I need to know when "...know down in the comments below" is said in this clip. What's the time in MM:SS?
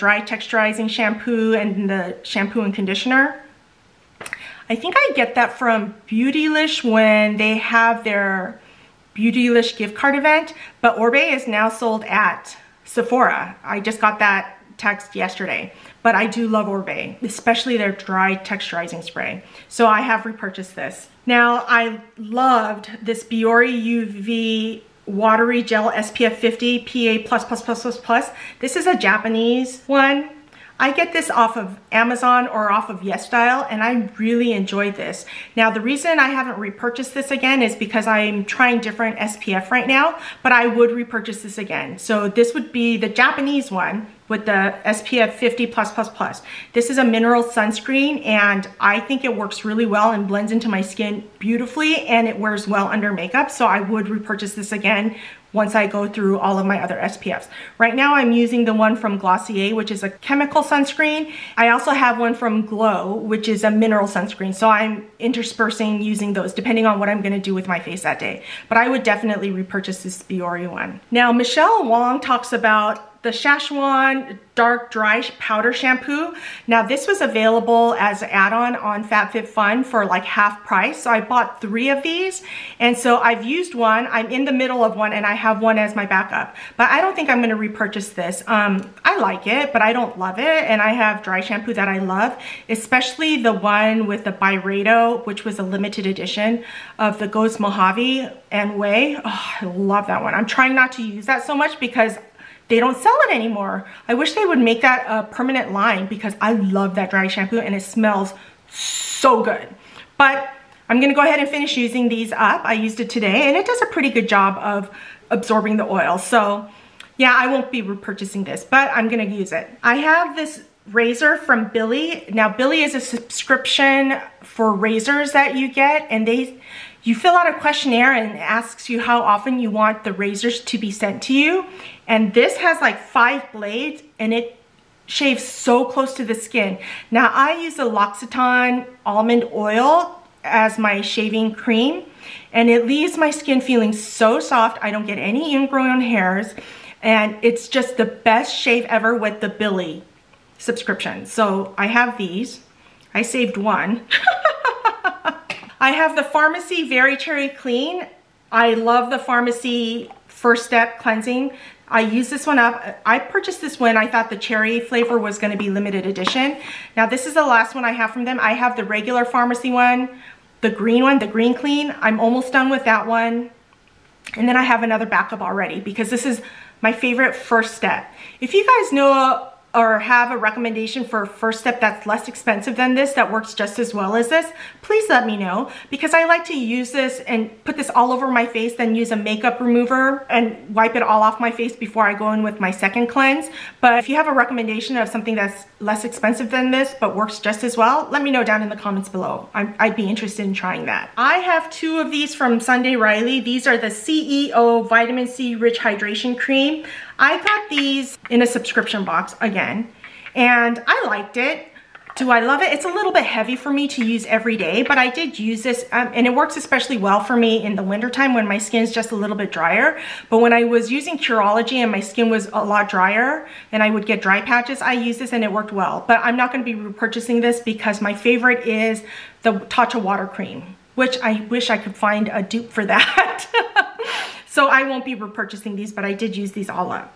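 03:18.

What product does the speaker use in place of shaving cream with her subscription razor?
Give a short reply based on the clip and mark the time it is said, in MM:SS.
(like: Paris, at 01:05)
L'Occitane almond oil, at 02:17.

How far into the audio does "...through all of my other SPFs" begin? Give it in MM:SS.
00:56.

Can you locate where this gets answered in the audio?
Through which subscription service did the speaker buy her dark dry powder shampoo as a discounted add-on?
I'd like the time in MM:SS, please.
01:19.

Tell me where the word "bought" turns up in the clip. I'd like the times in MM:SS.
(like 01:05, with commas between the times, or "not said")
01:21.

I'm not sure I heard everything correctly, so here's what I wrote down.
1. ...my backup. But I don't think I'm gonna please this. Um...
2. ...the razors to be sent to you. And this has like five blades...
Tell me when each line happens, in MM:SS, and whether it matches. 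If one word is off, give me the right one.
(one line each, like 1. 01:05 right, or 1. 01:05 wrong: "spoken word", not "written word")
1. 01:25 wrong: "repurchase", not "please"
2. 02:10 right.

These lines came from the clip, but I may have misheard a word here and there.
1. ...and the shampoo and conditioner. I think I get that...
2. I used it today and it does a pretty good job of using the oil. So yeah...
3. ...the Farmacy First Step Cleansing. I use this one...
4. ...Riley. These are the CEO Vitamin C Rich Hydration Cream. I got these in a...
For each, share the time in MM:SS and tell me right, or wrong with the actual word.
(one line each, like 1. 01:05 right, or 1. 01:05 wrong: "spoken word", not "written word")
1. 00:01 right
2. 01:52 wrong: "absorbing", not "using"
3. 02:39 right
4. 03:22 right.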